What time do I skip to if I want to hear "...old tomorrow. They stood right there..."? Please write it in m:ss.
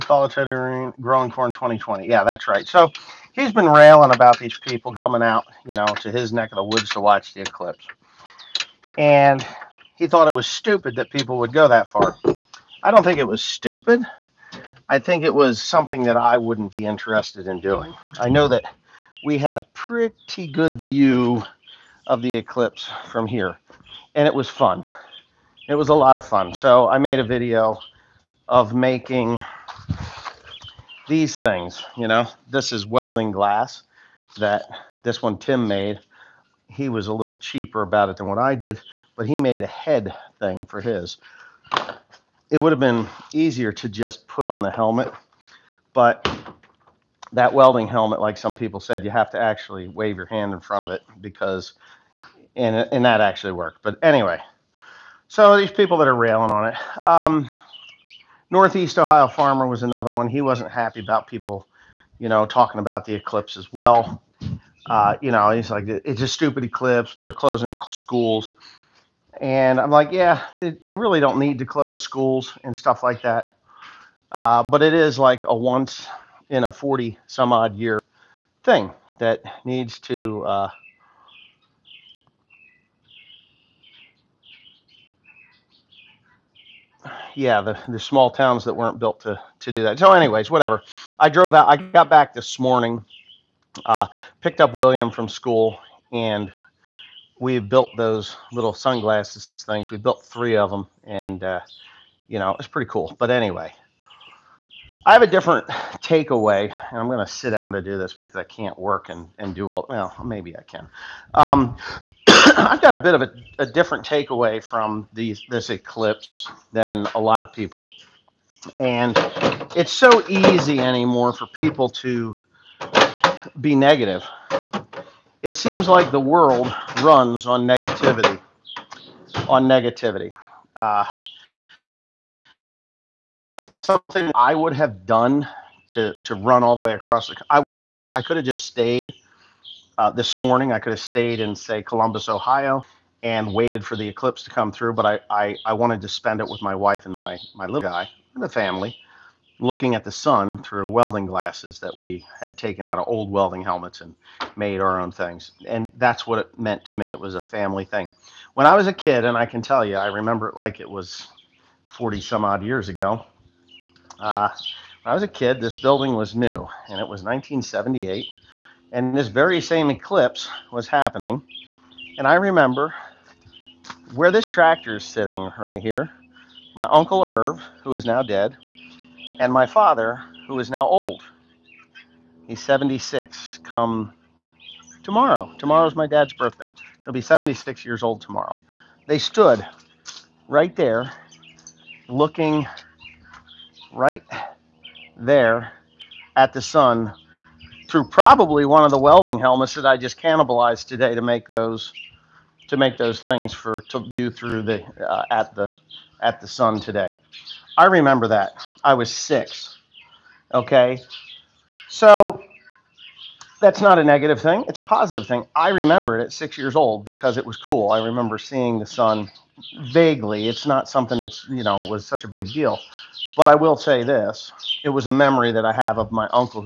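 3:08.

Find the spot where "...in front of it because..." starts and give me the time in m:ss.
0:50.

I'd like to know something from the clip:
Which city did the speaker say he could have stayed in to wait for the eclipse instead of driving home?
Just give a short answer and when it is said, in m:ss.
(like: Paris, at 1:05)
Columbus, Ohio, at 2:21.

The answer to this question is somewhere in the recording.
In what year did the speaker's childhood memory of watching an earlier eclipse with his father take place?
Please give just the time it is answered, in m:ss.
2:47.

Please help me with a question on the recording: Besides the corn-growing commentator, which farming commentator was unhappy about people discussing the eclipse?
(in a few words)
Northeast Ohio Farmer.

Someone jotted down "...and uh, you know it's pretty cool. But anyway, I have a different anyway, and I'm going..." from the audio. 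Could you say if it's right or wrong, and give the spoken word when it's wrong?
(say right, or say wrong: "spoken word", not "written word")
wrong: "takeaway", not "anyway".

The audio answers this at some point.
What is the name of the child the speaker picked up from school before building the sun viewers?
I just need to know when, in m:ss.
1:34.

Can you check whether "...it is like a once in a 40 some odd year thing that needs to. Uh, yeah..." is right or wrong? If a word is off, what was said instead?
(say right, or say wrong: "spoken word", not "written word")
right.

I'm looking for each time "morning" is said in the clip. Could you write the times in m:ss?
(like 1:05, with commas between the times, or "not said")
1:32, 2:20.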